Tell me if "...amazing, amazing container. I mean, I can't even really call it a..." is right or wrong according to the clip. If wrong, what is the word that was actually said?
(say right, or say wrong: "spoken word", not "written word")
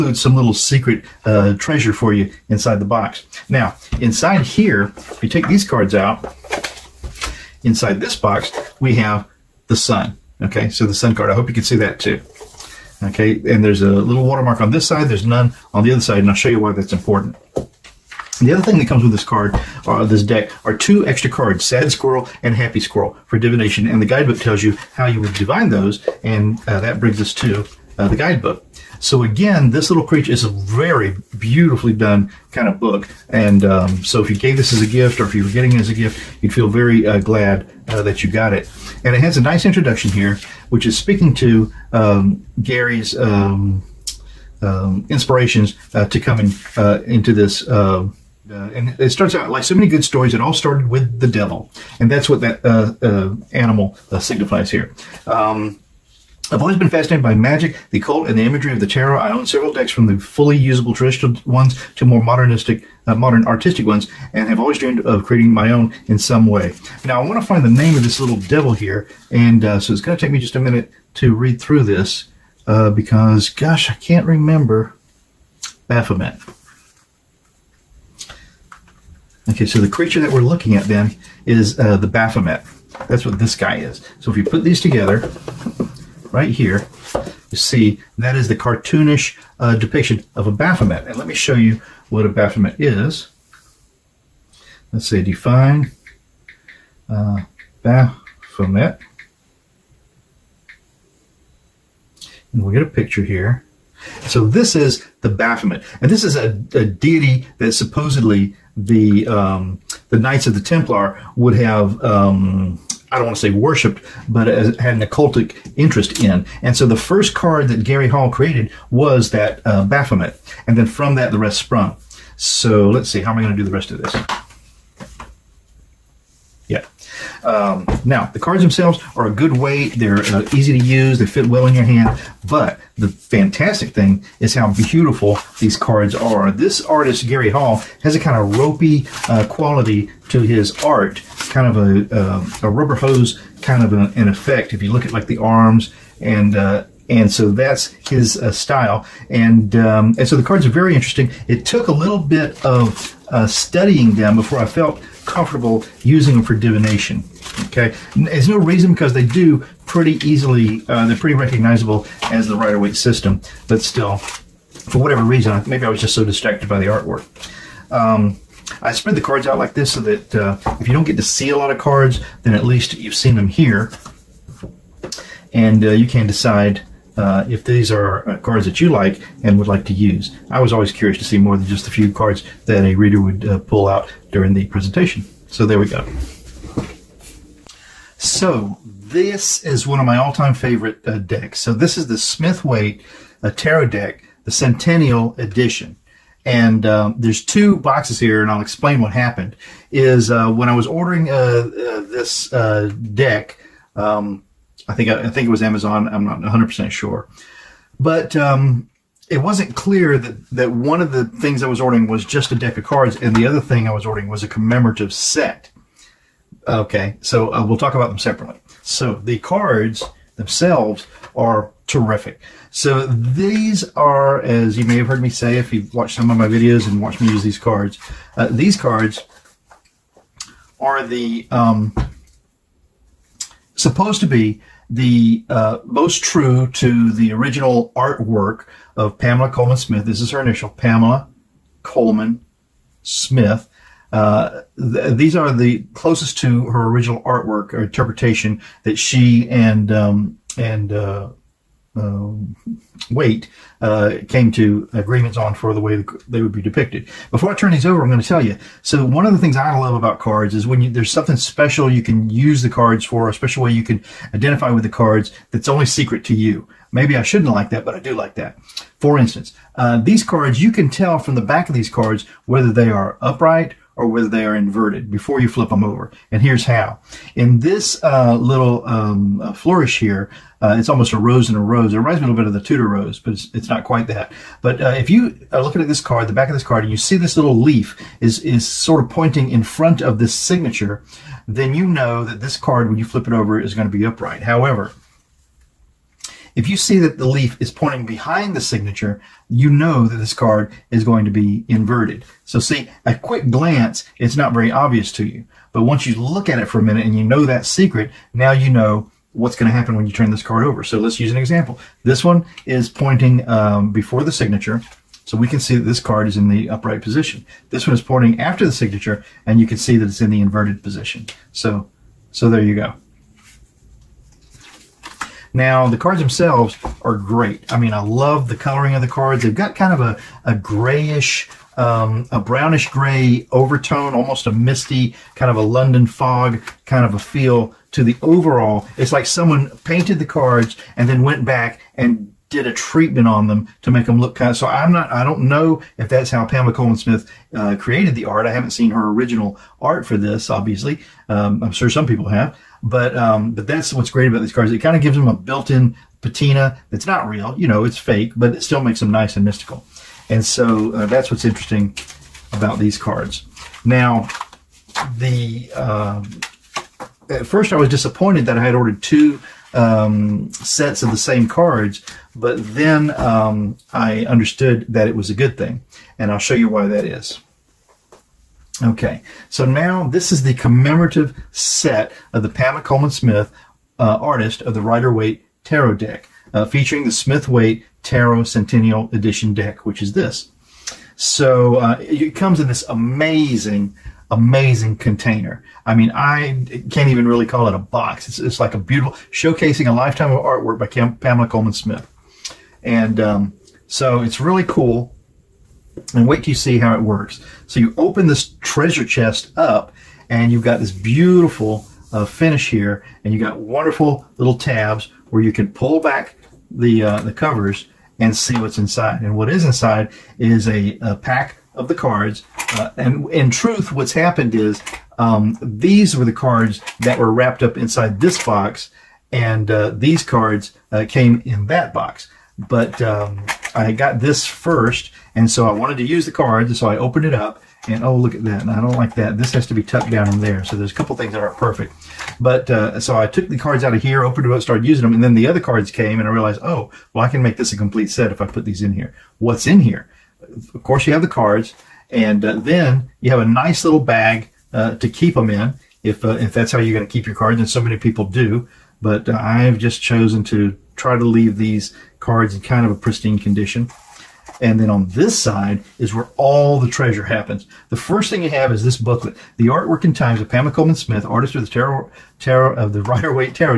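right.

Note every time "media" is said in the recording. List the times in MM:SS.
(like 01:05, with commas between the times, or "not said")
not said.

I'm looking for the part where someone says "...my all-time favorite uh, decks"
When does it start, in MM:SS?
03:10.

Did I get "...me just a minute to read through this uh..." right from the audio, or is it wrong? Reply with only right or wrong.
right.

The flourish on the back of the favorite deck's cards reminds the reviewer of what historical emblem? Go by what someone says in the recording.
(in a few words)
Tudor rose.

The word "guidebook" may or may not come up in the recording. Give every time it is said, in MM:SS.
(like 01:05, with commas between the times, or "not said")
00:24, 00:28.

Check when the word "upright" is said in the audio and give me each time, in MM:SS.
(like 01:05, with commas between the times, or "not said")
04:33, 04:54, 05:16.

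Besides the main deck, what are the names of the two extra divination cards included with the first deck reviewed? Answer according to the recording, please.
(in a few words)
Sad Squirrel and Happy Squirrel.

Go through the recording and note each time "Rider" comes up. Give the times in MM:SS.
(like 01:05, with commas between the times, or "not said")
02:42, 06:24, 07:53.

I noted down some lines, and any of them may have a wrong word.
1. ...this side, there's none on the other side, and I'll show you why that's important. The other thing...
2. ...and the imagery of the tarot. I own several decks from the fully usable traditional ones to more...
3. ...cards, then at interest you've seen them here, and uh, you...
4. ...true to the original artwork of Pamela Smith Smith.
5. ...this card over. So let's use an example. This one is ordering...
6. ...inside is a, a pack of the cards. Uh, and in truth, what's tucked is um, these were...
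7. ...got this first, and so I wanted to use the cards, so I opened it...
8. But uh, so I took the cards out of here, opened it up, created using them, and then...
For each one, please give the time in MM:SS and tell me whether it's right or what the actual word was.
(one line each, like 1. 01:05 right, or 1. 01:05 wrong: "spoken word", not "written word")
1. 00:14 right
2. 00:58 right
3. 02:51 wrong: "least", not "interest"
4. 03:56 wrong: "Colman", not "Smith"
5. 05:10 wrong: "pointing", not "ordering"
6. 06:59 wrong: "happened", not "tucked"
7. 07:13 right
8. 07:22 wrong: "started", not "created".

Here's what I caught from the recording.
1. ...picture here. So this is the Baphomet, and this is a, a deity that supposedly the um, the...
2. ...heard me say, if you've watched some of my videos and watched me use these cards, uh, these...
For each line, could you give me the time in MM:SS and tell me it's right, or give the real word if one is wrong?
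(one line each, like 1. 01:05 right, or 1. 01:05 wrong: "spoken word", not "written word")
1. 01:42 right
2. 03:45 right.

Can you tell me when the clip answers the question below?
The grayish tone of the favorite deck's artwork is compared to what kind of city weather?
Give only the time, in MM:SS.
05:35.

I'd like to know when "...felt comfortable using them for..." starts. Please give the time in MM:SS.
02:34.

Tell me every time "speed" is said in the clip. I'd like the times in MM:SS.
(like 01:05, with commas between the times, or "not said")
not said.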